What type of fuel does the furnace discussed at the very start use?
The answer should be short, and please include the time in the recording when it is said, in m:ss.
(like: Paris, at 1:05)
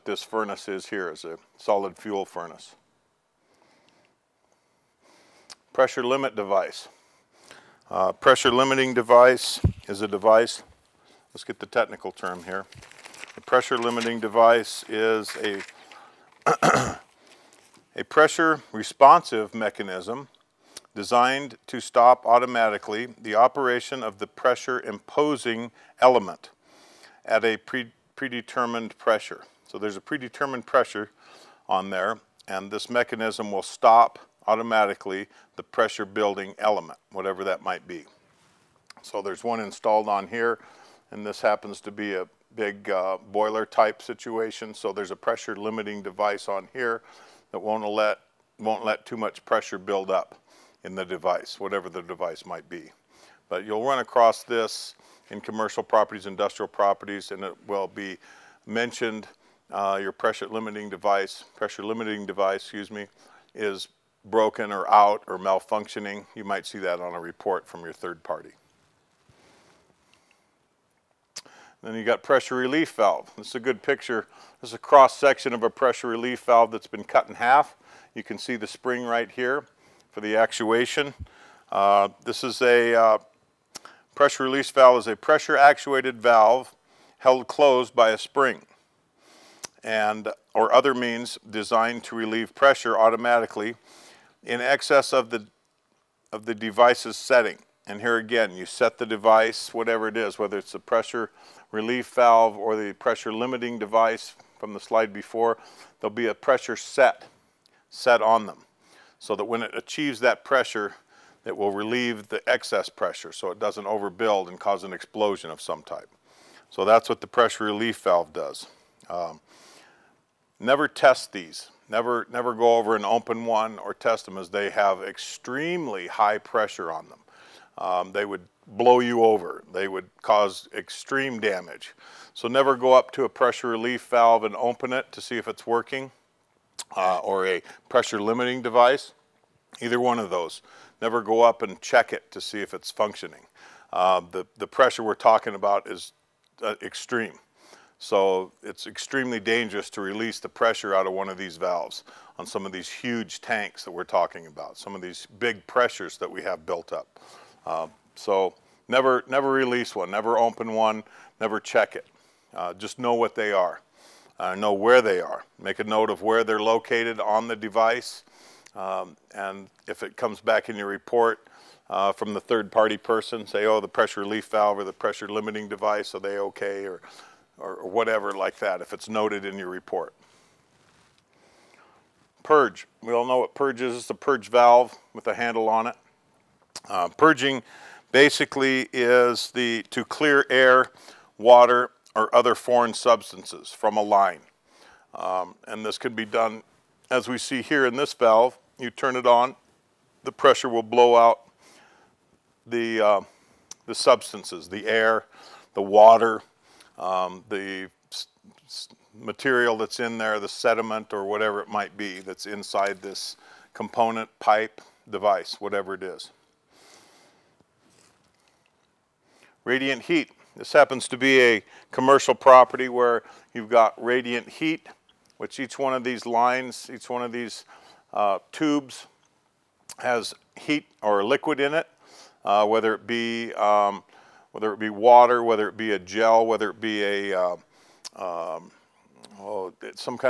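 Solid fuel, at 0:01.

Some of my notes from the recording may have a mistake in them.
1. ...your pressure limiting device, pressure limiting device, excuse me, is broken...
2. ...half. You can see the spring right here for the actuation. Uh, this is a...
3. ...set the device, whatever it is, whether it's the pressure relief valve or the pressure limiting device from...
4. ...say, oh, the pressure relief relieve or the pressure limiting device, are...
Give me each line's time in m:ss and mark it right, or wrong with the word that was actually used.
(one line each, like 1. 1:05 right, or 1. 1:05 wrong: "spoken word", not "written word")
1. 1:00 right
2. 1:17 right
3. 1:38 right
4. 2:53 wrong: "valve", not "relieve".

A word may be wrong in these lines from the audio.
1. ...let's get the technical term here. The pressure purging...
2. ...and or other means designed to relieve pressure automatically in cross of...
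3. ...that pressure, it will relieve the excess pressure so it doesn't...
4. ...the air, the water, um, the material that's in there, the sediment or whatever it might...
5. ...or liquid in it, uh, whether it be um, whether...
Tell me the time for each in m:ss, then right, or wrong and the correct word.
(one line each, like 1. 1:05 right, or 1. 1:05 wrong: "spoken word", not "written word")
1. 0:11 wrong: "limiting", not "purging"
2. 1:29 wrong: "excess", not "cross"
3. 1:50 right
4. 3:24 right
5. 3:51 right.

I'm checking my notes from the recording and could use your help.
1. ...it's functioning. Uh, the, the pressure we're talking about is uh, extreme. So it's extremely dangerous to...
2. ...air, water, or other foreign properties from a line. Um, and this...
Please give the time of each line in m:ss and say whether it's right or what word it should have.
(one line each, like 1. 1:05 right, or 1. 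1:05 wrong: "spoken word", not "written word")
1. 2:22 right
2. 3:10 wrong: "substances", not "properties".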